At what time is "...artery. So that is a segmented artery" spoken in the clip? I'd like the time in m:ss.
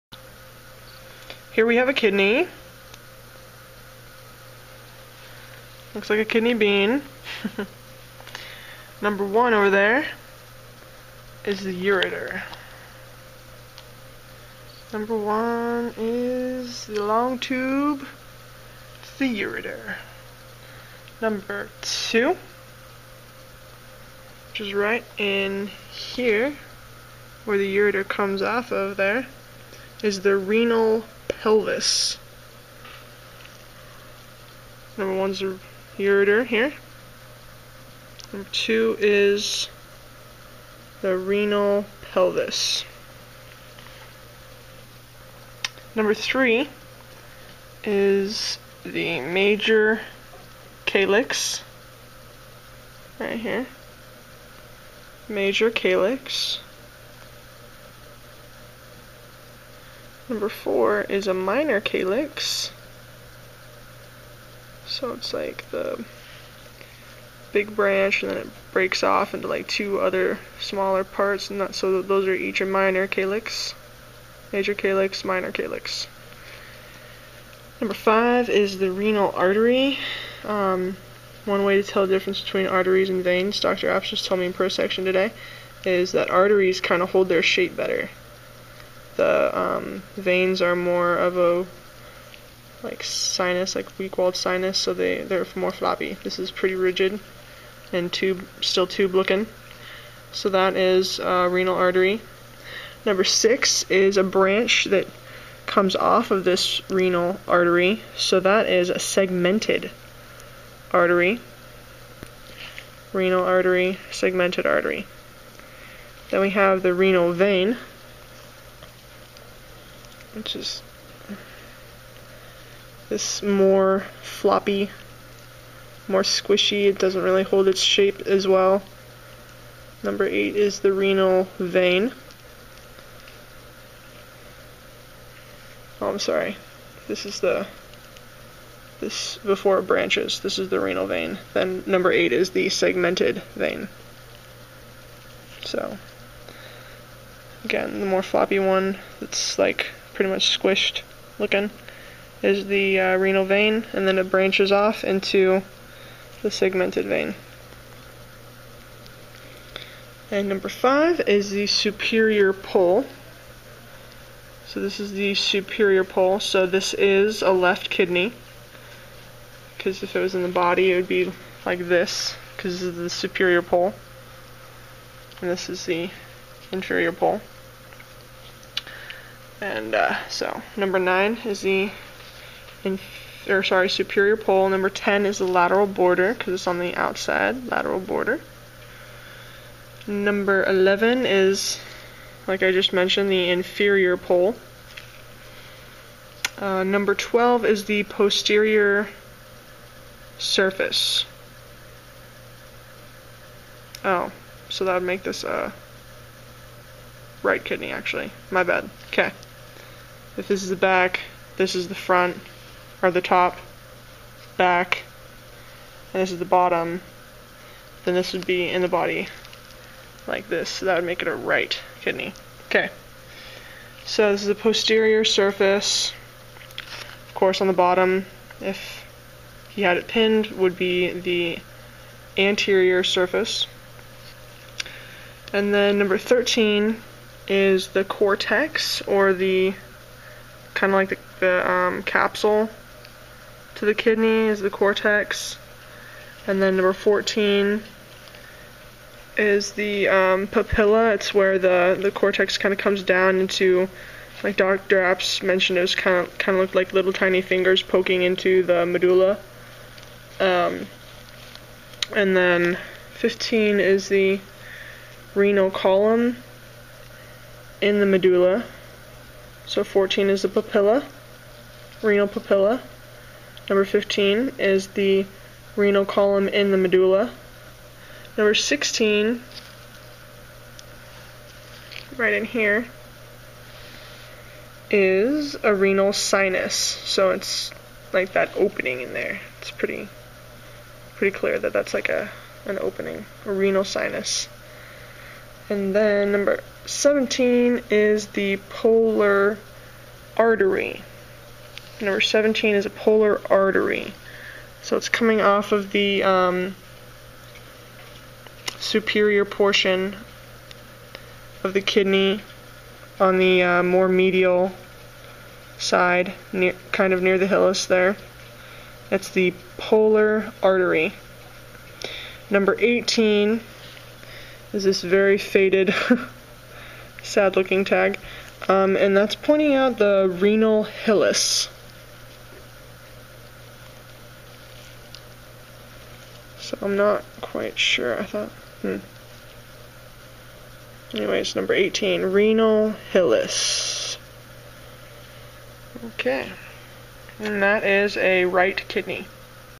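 1:47.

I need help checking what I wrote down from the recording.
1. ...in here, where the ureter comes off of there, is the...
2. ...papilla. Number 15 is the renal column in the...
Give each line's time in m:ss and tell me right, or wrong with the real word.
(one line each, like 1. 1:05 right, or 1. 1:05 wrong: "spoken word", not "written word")
1. 0:25 right
2. 4:32 right.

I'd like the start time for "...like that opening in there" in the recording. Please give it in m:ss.
4:48.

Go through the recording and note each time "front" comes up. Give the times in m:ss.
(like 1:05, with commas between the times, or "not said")
3:31.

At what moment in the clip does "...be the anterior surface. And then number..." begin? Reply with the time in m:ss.
3:50.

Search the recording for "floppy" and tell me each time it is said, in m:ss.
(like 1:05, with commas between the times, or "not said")
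1:35, 2:04, 2:28.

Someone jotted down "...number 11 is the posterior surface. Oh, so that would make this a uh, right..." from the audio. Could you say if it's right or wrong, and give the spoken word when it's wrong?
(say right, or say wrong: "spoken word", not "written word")
wrong: "12", not "11".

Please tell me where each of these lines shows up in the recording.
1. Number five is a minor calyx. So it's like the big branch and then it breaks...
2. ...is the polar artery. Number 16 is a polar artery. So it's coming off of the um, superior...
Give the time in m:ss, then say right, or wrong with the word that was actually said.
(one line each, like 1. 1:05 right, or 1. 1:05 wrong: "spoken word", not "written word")
1. 1:00 wrong: "four", not "five"
2. 4:57 wrong: "17", not "16".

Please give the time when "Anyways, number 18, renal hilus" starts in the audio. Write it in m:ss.
5:41.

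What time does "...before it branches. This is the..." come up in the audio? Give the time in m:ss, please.
2:19.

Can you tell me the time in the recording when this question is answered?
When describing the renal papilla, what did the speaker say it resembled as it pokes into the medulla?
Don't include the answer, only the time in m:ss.
4:16.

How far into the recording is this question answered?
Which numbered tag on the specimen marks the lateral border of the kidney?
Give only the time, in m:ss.
3:04.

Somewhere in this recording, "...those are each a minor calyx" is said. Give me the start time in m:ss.
1:12.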